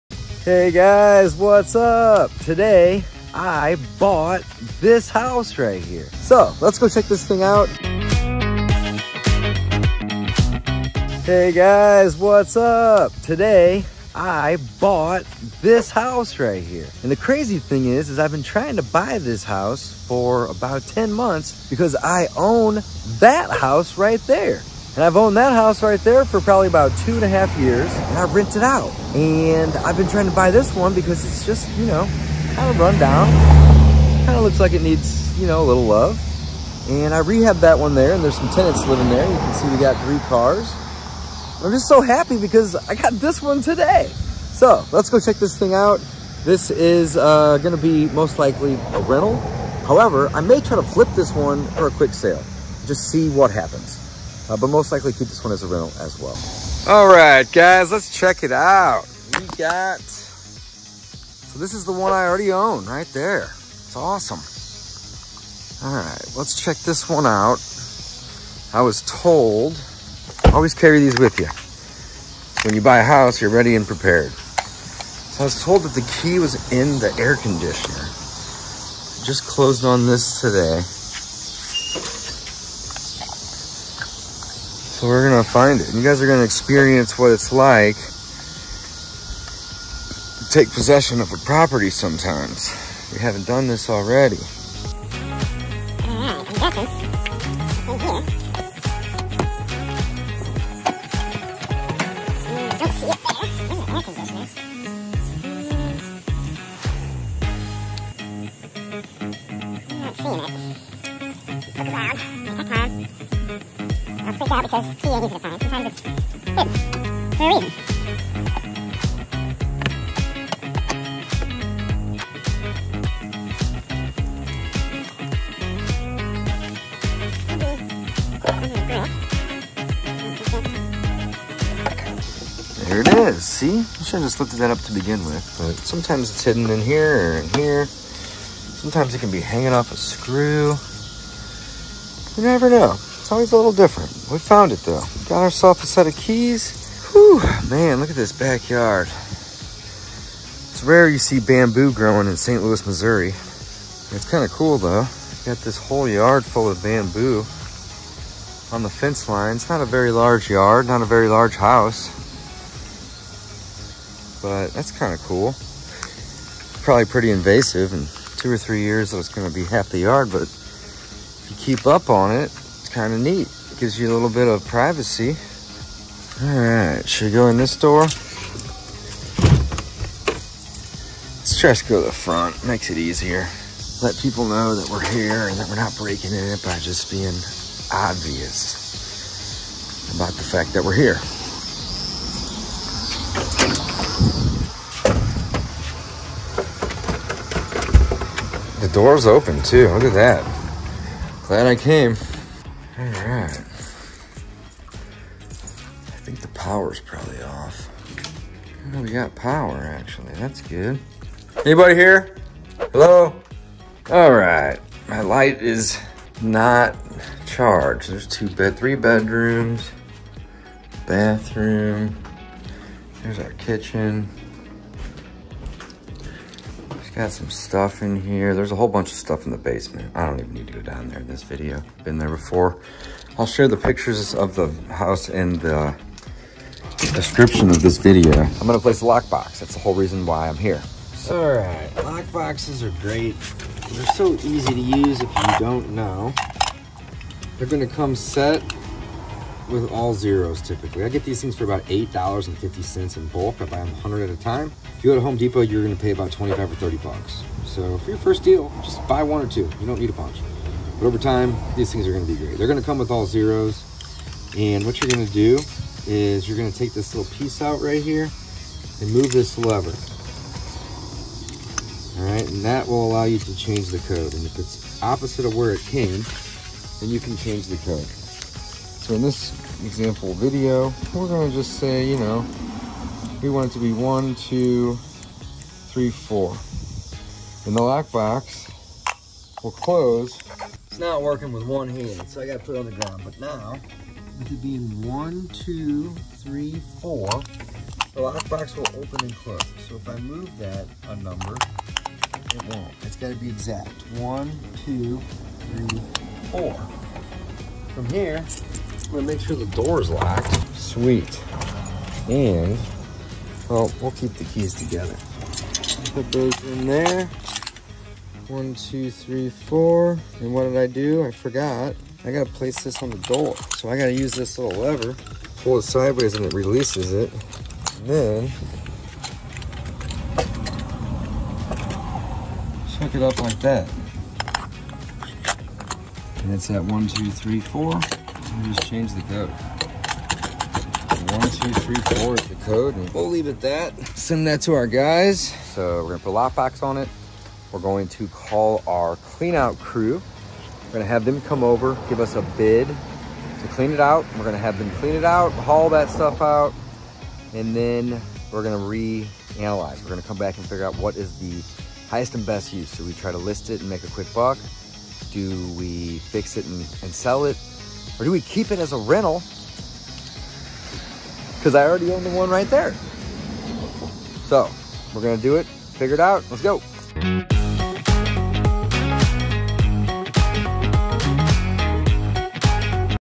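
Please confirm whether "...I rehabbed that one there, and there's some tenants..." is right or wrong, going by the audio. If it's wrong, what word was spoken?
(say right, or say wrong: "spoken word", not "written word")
right.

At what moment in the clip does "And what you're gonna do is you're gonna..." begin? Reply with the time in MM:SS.
04:24.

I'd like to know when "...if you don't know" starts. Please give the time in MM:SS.
04:05.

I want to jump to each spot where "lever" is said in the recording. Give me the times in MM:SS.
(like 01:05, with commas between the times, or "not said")
04:29, 05:24.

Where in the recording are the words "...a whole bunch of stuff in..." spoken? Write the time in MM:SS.
03:48.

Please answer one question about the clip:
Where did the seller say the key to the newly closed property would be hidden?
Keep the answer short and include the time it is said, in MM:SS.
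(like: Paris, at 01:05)
In the air conditioner, at 01:16.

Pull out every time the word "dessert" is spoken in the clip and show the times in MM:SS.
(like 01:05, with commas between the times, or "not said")
not said.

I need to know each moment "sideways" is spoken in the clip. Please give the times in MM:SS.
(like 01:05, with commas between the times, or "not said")
05:25.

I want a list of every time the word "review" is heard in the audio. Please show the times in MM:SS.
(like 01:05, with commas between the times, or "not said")
not said.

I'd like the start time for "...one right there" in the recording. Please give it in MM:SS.
06:12.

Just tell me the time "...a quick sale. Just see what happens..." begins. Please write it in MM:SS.
00:51.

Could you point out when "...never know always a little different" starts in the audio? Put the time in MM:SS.
02:22.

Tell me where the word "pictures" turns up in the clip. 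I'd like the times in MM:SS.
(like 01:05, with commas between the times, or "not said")
03:53.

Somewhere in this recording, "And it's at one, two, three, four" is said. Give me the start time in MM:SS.
05:36.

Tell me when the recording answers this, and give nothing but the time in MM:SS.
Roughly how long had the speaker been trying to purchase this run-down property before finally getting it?
00:20.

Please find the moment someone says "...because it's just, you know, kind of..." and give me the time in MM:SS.
00:30.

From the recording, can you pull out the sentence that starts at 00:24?
And I've owned that house right there for probably about two and a half years.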